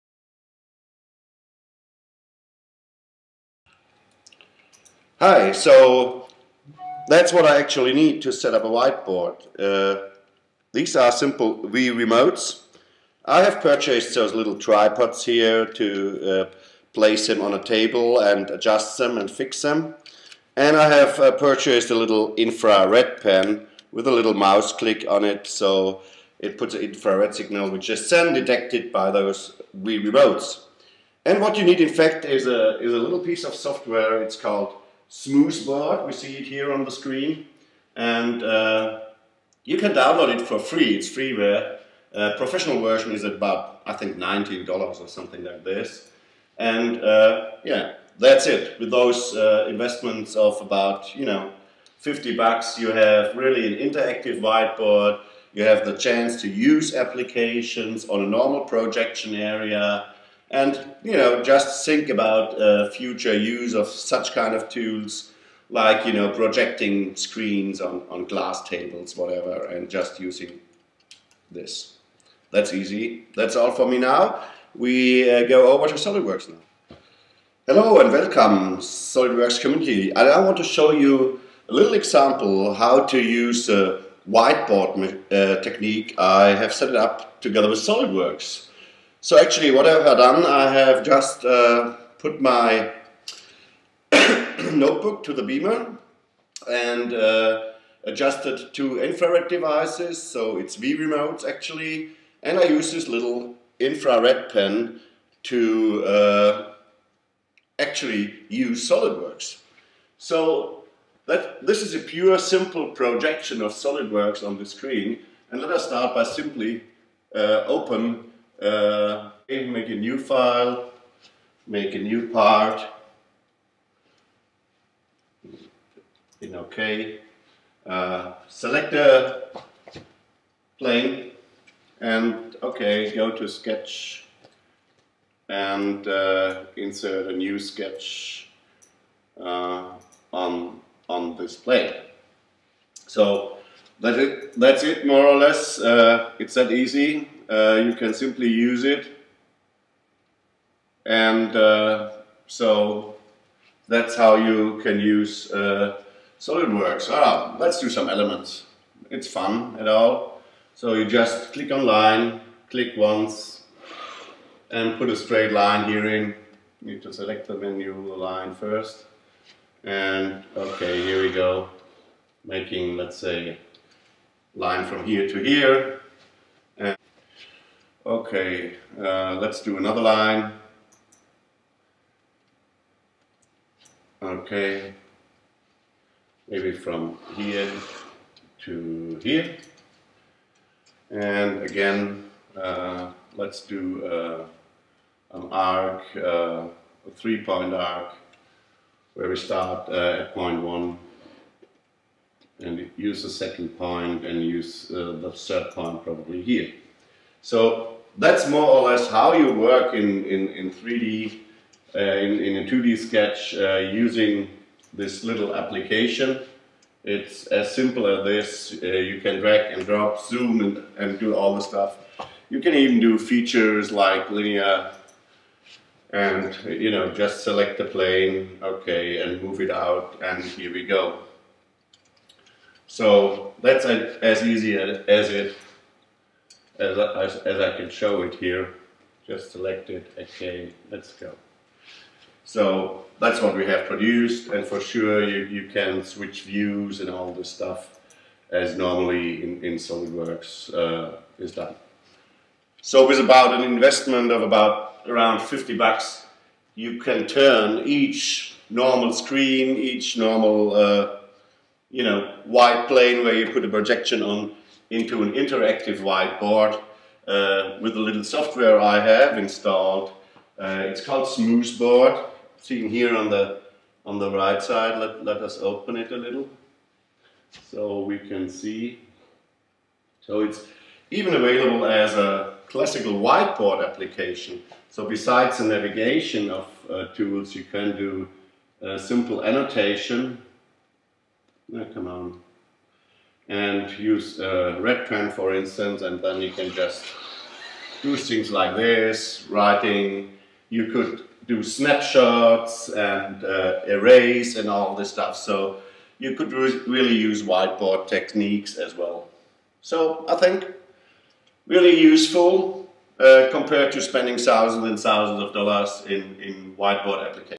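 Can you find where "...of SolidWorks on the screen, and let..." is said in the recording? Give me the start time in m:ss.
1:53.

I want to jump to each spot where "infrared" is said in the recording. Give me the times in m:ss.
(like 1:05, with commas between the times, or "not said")
0:22, 0:26, 1:39, 1:43.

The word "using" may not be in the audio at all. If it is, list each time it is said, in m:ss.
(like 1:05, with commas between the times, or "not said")
1:10, 3:33.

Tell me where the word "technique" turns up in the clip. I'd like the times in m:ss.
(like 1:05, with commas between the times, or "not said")
1:25, 5:08.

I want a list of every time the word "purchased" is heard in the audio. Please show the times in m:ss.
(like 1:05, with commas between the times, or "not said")
0:13, 0:21.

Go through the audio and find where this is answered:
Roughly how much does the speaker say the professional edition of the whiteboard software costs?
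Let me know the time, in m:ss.
0:44.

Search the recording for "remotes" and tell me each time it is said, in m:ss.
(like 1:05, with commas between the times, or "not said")
0:11, 0:30, 1:40.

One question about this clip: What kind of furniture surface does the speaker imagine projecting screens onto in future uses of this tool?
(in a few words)
glass tables.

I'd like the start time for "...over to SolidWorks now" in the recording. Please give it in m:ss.
1:15.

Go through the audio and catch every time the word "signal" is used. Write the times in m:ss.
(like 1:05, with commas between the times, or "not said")
0:27.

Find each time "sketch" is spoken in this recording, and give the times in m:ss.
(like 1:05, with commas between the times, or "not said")
2:13, 2:17, 3:32.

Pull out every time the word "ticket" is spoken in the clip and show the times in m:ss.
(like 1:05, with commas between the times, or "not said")
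not said.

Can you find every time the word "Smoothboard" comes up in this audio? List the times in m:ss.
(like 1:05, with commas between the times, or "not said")
0:35, 4:31.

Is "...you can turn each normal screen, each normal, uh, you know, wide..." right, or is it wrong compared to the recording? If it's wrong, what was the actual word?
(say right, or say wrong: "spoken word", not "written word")
right.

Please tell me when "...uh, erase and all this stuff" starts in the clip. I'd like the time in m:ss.
5:03.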